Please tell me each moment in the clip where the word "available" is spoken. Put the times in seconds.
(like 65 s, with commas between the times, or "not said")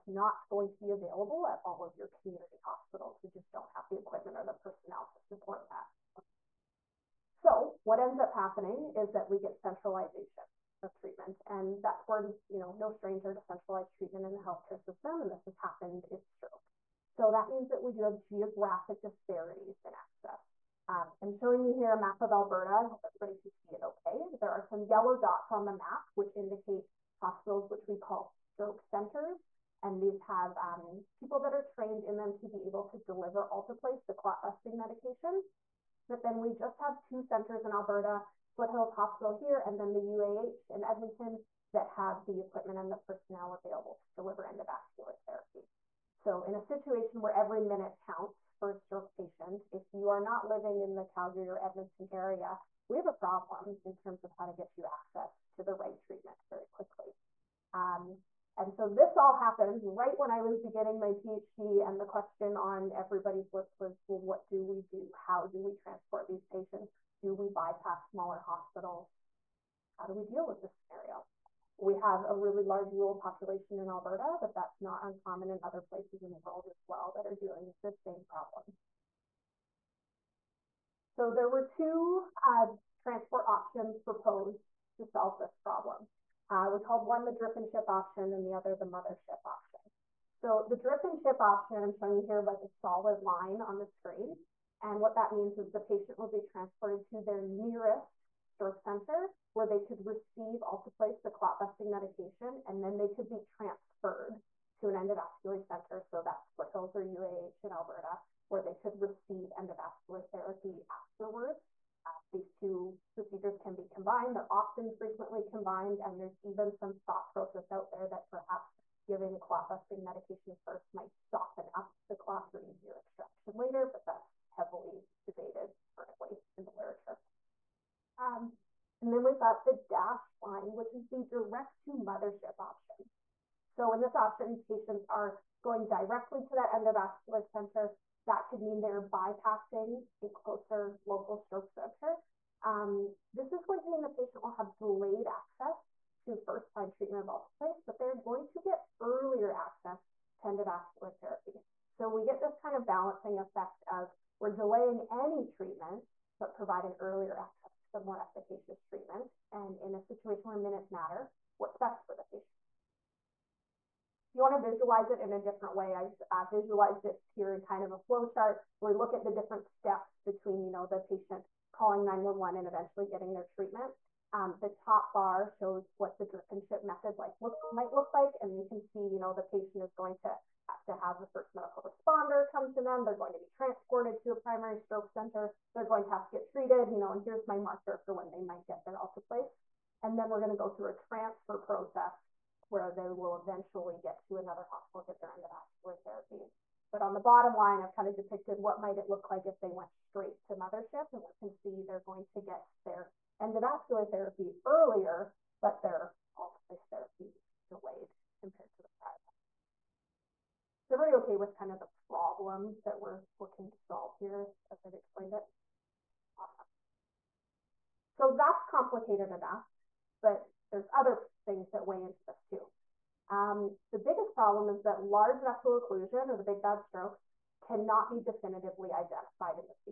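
0 s, 43 s.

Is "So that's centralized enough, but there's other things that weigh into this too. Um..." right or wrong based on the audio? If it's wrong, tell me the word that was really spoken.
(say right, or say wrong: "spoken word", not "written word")
wrong: "complicated", not "centralized".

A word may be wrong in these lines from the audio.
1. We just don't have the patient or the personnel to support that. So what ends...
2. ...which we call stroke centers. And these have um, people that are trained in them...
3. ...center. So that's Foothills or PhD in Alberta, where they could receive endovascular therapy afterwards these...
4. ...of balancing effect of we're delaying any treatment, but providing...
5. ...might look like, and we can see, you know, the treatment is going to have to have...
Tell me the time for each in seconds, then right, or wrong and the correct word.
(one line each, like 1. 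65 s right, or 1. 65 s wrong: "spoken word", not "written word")
1. 3 s wrong: "equipment", not "patient"
2. 27 s right
3. 105 s wrong: "UAH", not "PhD"
4. 152 s right
5. 177 s wrong: "patient", not "treatment".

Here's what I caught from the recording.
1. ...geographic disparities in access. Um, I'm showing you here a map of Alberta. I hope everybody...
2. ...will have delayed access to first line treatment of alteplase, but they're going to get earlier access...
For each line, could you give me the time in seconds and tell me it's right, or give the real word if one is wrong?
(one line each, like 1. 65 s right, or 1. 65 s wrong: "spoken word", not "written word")
1. 18 s right
2. 144 s right.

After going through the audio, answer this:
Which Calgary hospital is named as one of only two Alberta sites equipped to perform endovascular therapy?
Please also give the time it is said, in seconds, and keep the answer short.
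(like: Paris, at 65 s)
Foothills Hospital, at 38 s.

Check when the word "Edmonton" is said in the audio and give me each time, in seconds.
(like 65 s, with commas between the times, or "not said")
40 s, 51 s.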